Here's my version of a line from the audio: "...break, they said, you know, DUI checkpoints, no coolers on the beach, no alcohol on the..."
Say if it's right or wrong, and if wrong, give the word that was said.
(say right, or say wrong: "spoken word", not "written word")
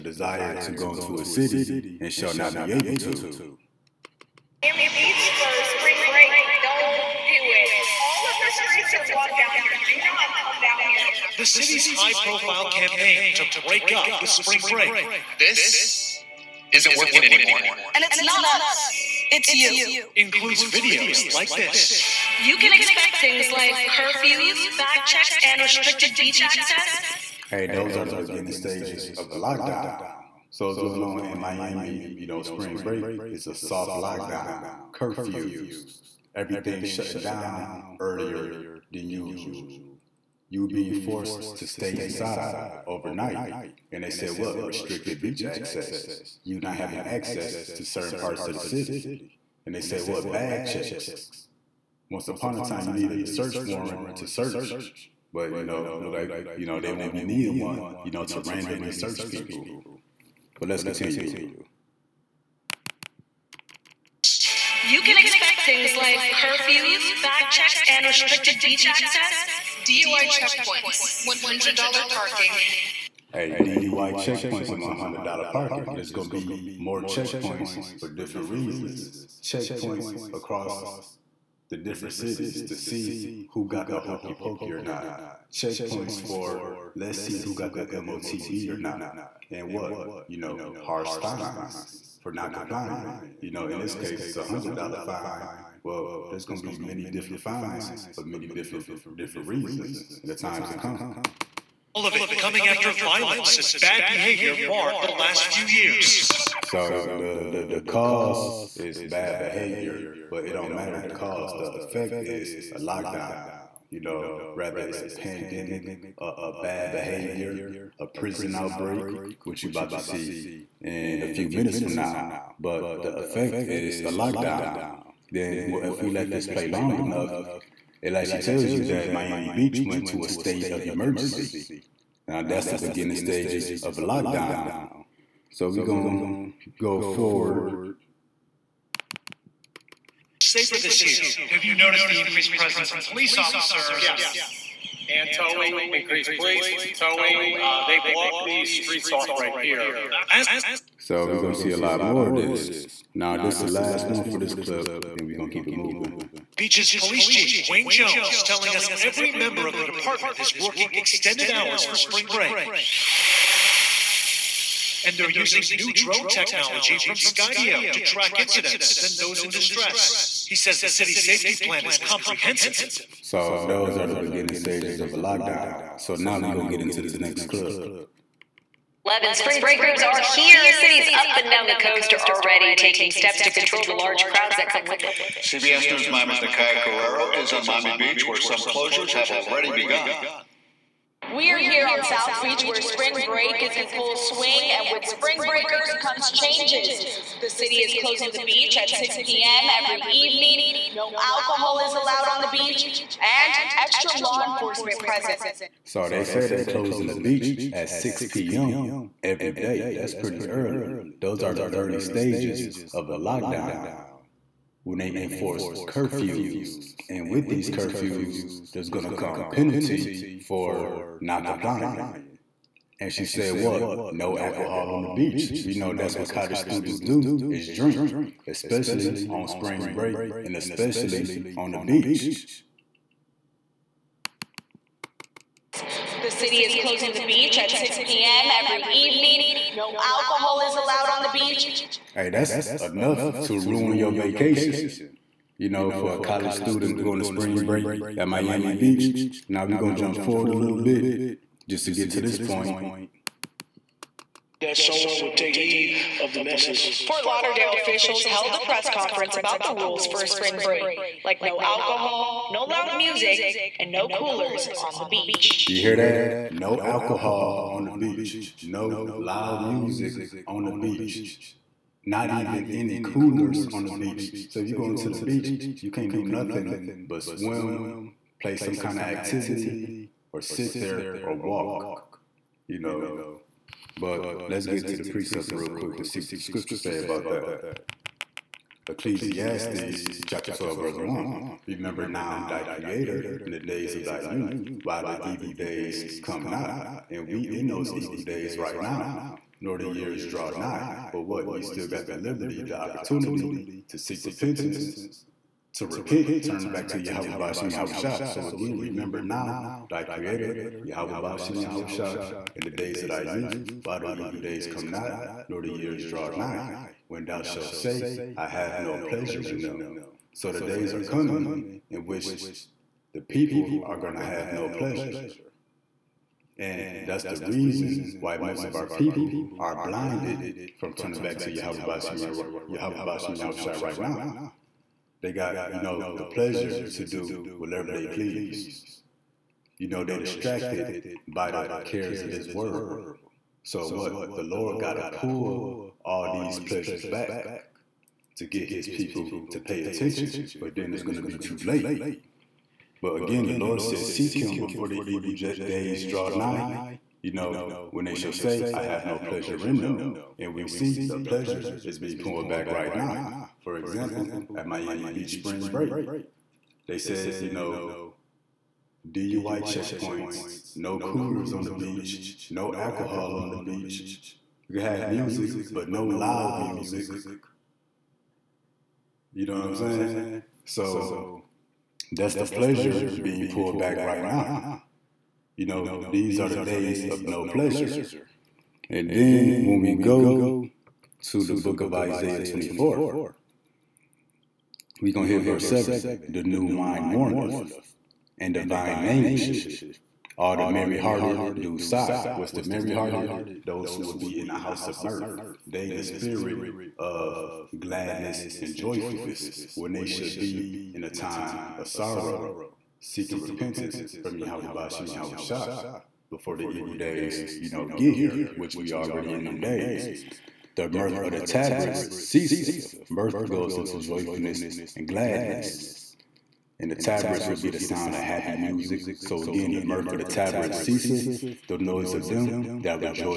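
right.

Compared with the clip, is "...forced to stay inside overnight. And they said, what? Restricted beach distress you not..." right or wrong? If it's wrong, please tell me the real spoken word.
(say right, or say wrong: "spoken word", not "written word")
wrong: "access", not "distress".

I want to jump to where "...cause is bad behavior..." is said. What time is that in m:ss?
1:47.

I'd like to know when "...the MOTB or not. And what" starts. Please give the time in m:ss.
1:27.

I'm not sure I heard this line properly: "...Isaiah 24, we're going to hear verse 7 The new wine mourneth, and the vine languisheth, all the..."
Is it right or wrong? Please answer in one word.
right.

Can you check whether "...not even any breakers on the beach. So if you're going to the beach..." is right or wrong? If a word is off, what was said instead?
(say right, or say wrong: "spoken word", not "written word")
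wrong: "coolers", not "breakers".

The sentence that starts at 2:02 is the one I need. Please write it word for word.
But the effect is a lockdown.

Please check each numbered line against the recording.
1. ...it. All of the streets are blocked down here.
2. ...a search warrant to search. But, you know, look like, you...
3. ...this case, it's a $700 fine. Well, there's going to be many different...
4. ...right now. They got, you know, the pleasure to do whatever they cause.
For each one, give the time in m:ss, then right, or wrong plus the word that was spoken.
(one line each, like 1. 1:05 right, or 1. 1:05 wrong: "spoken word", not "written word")
1. 0:07 right
2. 0:53 right
3. 1:33 wrong: "100", not "700"
4. 5:33 wrong: "please", not "cause".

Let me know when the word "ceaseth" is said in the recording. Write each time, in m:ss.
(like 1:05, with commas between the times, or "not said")
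7:02, 7:10.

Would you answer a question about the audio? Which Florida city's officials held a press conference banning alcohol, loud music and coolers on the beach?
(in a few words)
Fort Lauderdale.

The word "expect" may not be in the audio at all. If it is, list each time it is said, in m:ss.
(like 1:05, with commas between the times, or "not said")
0:22, 1:05.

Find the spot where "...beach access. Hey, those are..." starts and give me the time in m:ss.
0:26.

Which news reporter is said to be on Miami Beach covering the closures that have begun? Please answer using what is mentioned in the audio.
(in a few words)
Nakia Carrero.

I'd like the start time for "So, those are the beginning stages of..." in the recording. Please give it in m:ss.
2:53.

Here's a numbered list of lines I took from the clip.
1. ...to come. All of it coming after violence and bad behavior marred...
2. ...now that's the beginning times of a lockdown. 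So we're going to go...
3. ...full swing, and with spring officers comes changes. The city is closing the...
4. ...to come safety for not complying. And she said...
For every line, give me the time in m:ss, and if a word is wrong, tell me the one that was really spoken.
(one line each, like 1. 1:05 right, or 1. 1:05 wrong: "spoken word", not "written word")
1. 1:40 right
2. 2:12 wrong: "stages", not "times"
3. 3:13 wrong: "breakers", not "officers"
4. 3:39 wrong: "penalty", not "safety".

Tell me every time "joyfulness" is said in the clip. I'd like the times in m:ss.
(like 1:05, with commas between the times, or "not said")
6:48, 7:03.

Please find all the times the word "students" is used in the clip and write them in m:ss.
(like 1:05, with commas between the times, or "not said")
3:46, 4:06.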